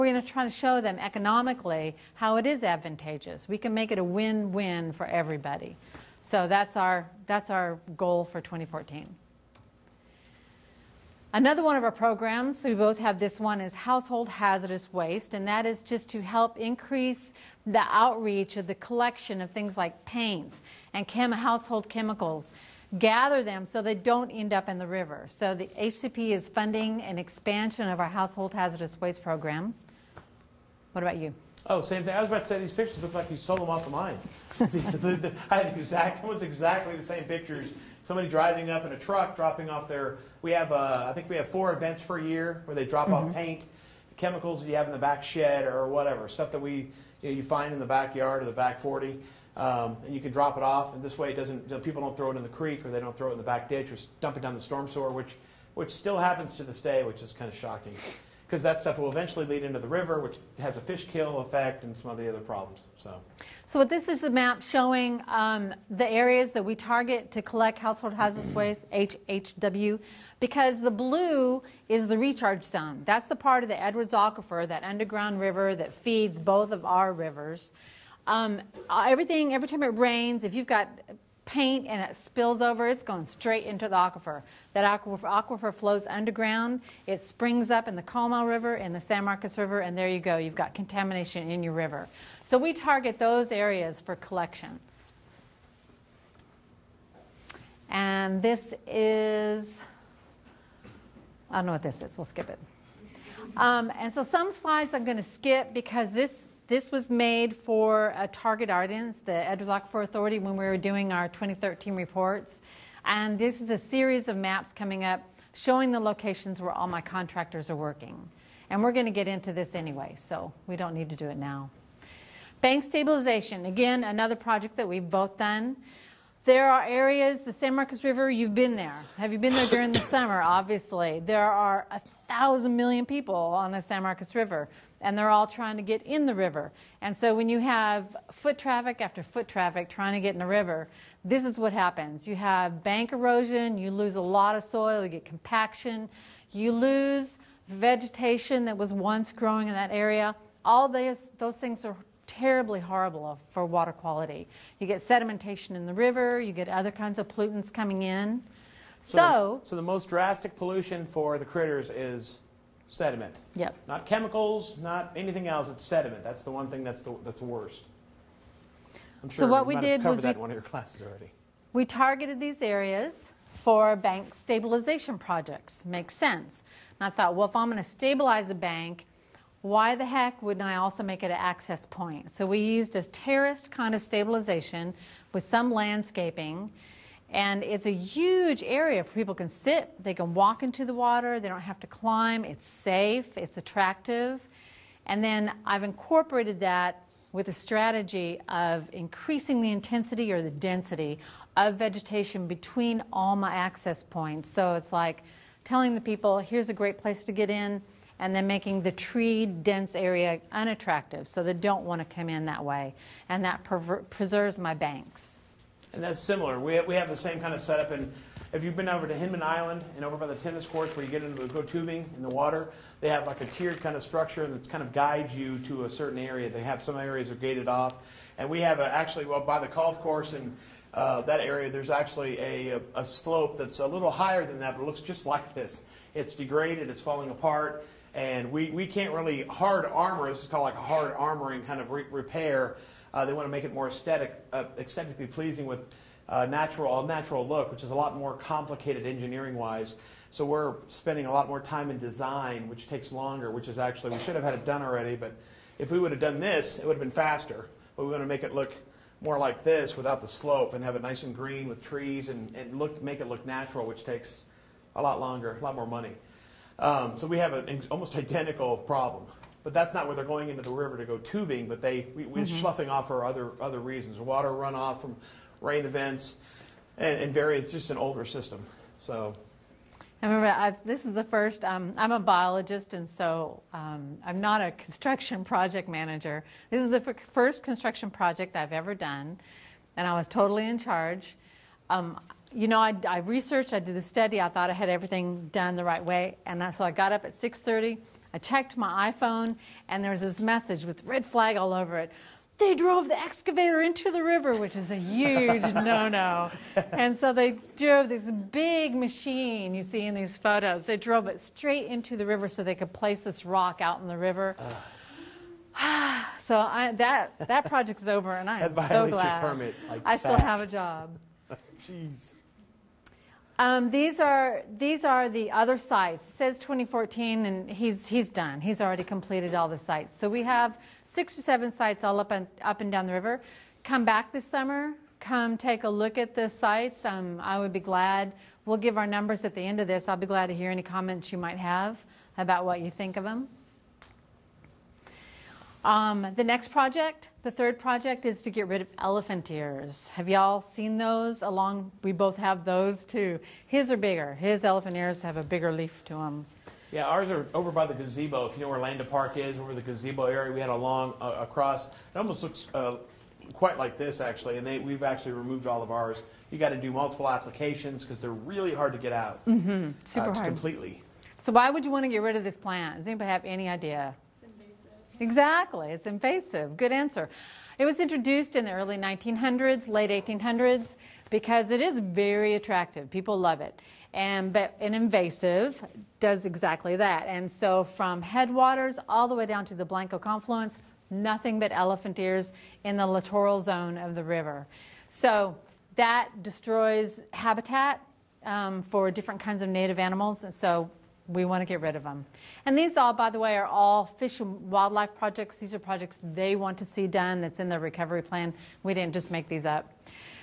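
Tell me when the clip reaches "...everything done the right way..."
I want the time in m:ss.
4:54.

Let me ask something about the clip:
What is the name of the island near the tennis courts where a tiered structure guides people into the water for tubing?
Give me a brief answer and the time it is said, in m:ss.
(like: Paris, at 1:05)
Hinman Island, at 3:39.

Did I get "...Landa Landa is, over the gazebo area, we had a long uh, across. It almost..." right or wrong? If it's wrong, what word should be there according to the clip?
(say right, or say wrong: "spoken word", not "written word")
wrong: "Park", not "Landa".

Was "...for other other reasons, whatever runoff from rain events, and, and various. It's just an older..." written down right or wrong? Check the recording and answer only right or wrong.
wrong.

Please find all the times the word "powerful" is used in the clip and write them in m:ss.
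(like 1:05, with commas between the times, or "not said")
not said.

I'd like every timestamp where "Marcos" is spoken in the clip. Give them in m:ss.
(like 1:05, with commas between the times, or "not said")
1:29, 2:07, 2:14.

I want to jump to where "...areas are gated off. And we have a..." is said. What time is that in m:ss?
3:46.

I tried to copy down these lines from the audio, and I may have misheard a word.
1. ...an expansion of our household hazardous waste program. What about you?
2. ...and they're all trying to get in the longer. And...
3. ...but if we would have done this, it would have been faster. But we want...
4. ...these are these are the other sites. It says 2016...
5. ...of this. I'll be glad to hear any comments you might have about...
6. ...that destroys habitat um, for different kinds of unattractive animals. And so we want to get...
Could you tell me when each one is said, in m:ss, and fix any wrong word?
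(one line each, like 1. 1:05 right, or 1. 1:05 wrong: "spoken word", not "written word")
1. 0:27 right
2. 2:15 wrong: "river", not "longer"
3. 4:15 right
4. 5:23 wrong: "2014", not "2016"
5. 5:39 right
6. 6:35 wrong: "native", not "unattractive".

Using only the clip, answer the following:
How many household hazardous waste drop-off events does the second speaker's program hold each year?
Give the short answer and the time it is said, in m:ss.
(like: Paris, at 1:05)
4, at 0:41.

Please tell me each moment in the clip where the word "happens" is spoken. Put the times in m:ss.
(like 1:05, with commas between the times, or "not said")
0:56, 2:21.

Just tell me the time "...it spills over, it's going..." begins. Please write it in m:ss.
1:22.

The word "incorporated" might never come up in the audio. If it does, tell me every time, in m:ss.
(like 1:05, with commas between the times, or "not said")
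3:15.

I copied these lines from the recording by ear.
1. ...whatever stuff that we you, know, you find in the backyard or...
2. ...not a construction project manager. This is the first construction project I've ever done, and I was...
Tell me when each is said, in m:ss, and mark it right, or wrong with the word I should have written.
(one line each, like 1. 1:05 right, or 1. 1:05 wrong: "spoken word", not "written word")
1. 0:45 right
2. 4:44 right.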